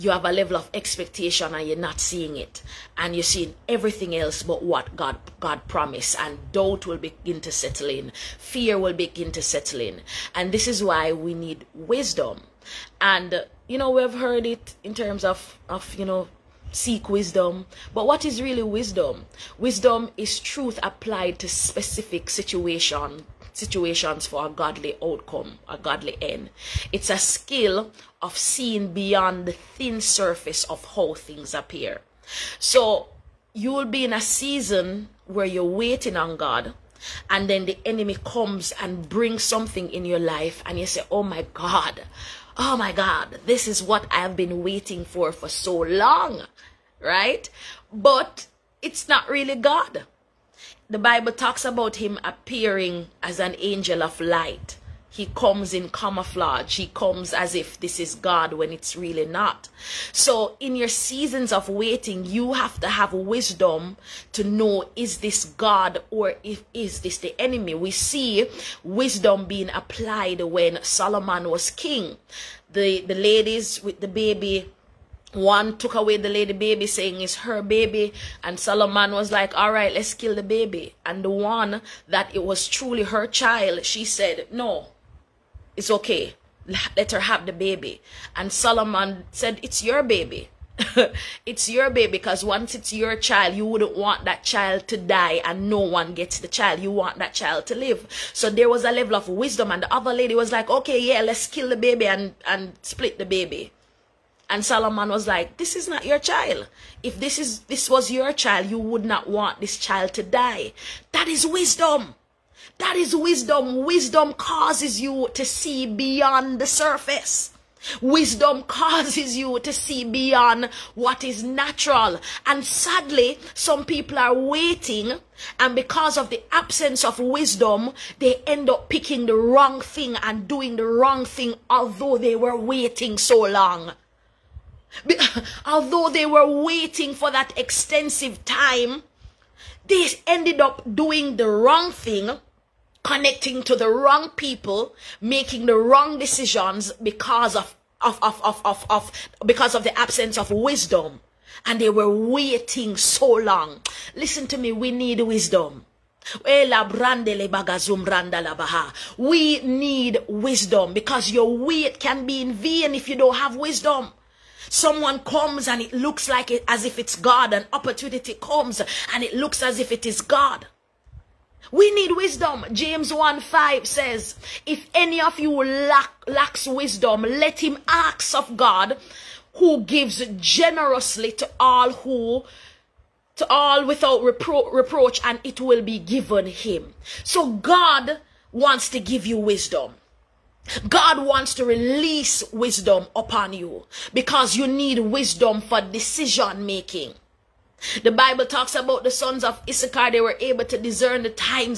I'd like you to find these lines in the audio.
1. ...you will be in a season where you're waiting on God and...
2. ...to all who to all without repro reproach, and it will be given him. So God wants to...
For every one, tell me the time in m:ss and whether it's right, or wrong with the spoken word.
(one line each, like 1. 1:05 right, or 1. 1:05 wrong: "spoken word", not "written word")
1. 0:33 right
2. 3:01 right.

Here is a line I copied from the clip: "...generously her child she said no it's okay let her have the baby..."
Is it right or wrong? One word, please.
wrong.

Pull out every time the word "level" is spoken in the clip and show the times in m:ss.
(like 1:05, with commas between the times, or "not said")
0:00, 1:38.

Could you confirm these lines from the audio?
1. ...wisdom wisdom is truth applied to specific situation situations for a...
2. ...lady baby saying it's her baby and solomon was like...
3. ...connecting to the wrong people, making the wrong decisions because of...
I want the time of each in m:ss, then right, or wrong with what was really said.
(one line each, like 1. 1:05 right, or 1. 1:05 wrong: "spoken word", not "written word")
1. 0:18 right
2. 1:16 right
3. 2:23 right.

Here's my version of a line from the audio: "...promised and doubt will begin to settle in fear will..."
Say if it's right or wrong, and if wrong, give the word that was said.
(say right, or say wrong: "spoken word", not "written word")
right.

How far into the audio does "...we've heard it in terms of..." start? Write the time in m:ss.
0:13.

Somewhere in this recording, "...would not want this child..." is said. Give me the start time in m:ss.
1:48.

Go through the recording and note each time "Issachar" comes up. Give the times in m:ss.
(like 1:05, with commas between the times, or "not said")
3:19.